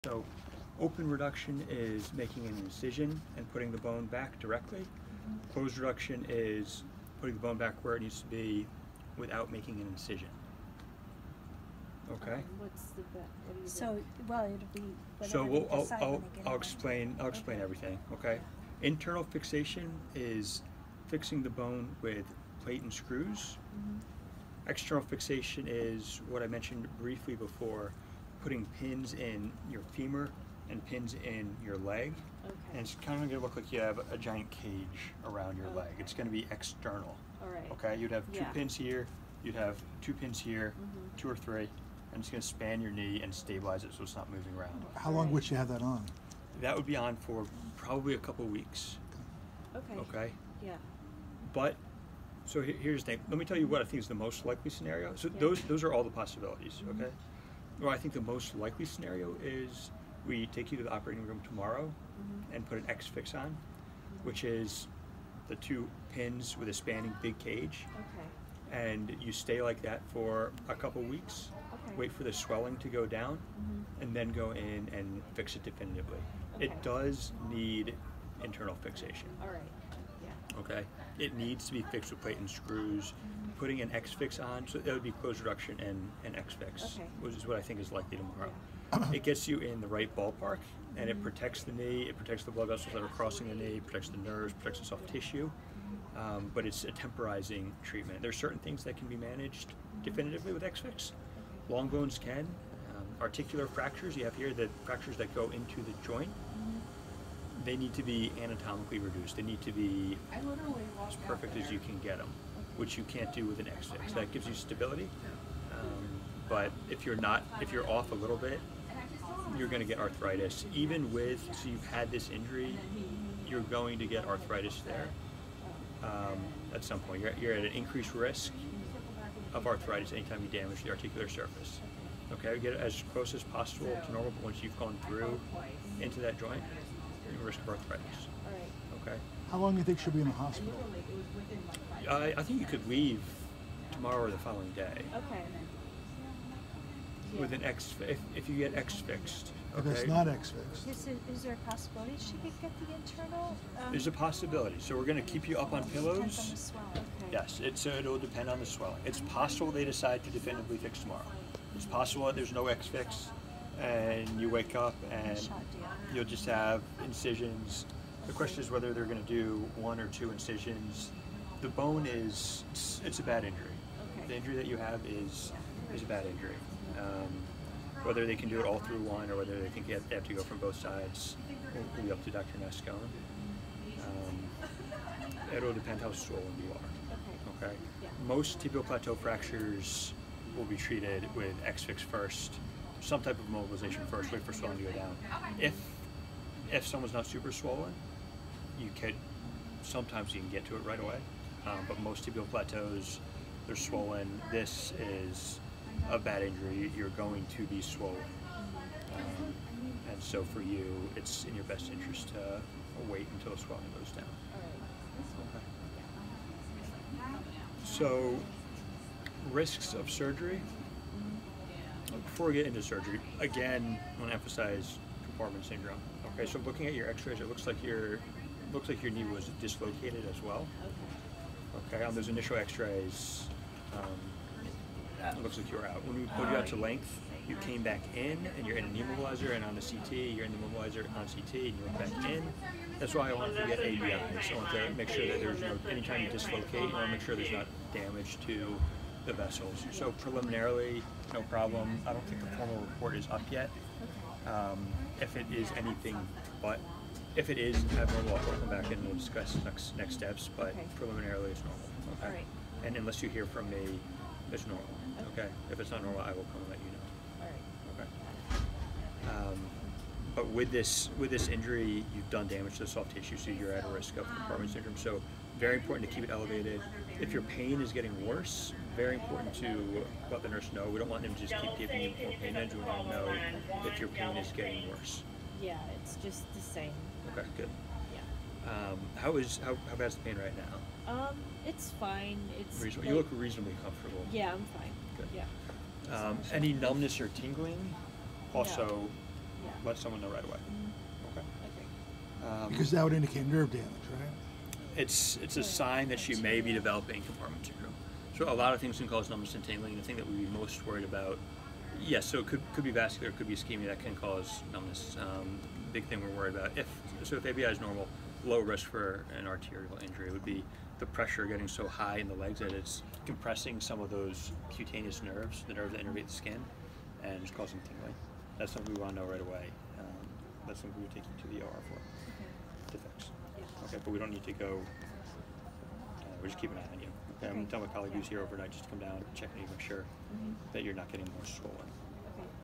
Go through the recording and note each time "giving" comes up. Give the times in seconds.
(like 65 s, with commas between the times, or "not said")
281 s.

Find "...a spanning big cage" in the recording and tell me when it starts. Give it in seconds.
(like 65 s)
66 s.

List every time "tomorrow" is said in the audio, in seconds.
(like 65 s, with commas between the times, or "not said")
61 s, 88 s, 143 s, 160 s.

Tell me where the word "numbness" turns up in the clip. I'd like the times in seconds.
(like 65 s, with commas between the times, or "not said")
296 s, 309 s, 314 s.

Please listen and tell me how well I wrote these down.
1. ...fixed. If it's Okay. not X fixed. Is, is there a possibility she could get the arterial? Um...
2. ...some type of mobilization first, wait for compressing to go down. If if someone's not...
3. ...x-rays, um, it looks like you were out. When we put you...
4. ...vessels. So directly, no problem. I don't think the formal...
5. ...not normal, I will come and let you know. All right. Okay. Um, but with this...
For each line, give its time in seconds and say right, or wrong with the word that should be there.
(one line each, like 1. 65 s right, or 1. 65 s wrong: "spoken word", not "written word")
1. 148 s wrong: "internal", not "arterial"
2. 193 s wrong: "swelling", not "compressing"
3. 232 s right
4. 249 s wrong: "preliminarily", not "directly"
5. 265 s right.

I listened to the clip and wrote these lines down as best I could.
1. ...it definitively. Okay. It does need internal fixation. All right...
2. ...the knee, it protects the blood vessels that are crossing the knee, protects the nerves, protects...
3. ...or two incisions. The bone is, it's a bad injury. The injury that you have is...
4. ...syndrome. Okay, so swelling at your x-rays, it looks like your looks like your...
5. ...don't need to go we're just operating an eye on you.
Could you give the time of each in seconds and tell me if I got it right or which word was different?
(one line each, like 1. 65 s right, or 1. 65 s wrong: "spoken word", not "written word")
1. 75 s right
2. 91 s right
3. 169 s right
4. 225 s wrong: "looking", not "swelling"
5. 334 s wrong: "keeping", not "operating".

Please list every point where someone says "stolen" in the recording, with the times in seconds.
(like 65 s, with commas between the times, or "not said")
341 s.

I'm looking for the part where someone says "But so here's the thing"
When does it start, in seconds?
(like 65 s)
51 s.